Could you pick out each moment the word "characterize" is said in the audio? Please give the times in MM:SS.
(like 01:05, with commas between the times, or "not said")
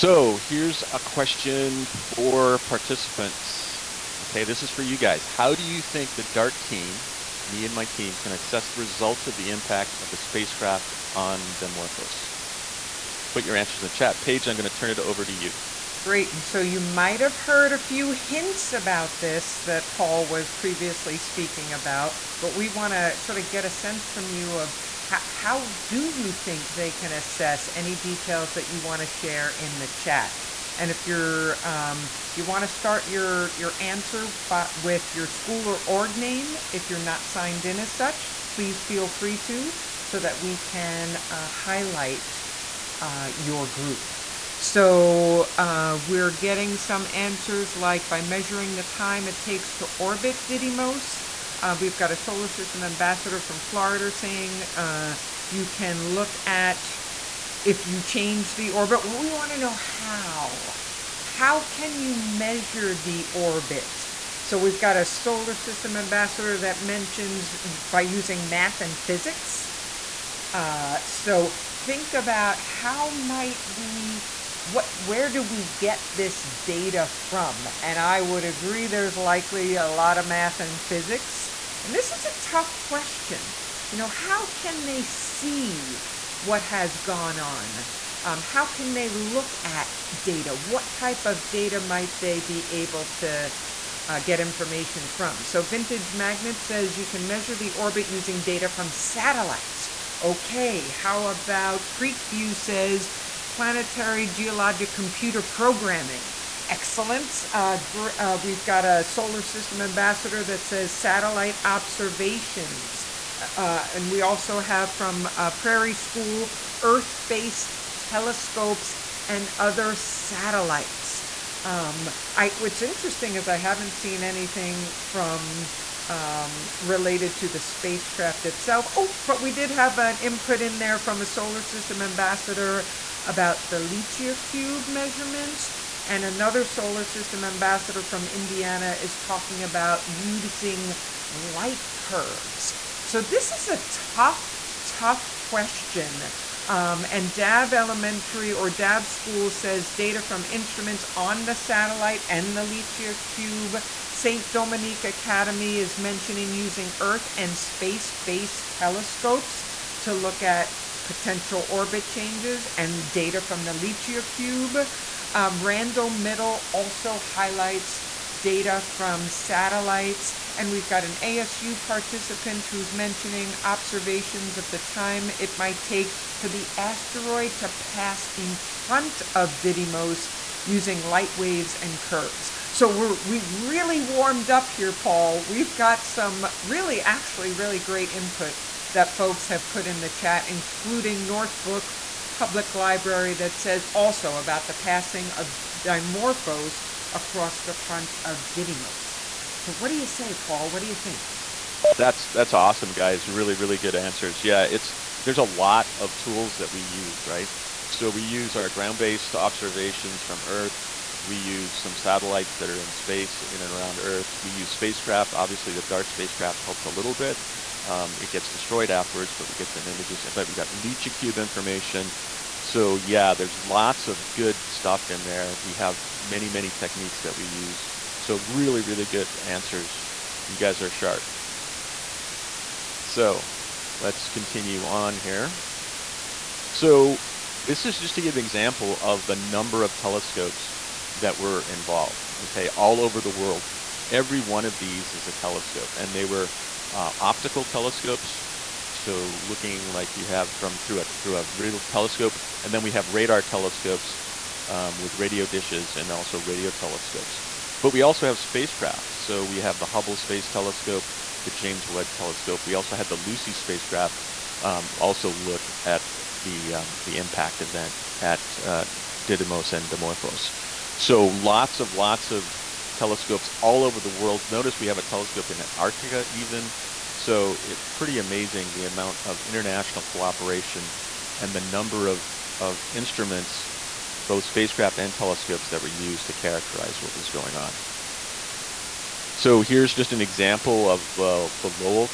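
04:46.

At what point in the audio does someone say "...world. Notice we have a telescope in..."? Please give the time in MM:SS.
04:34.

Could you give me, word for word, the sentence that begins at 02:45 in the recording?
Um, Randall Middle also highlights data from satellites.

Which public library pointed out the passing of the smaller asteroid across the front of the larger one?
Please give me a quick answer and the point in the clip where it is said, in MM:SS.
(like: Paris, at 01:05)
Northbrook Public Library, at 03:11.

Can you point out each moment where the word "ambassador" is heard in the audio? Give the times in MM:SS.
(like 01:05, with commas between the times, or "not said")
00:52, 01:05, 01:49, 02:12, 02:17.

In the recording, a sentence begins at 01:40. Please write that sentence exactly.
Okay, how about Creekview says planetary geologic computer programming.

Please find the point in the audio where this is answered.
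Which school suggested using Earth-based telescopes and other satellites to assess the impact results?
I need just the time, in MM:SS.
01:55.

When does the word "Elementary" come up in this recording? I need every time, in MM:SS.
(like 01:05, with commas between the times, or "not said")
02:27.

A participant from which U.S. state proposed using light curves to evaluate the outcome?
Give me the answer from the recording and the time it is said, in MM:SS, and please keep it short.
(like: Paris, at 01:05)
Indiana, at 02:18.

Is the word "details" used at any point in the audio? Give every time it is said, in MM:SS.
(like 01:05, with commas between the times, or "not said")
00:27.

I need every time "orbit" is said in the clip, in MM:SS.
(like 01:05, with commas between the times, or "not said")
00:49, 00:58, 01:03, 01:37, 02:41.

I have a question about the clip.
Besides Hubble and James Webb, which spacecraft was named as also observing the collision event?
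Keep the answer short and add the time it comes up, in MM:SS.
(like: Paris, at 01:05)
Lucy, at 04:23.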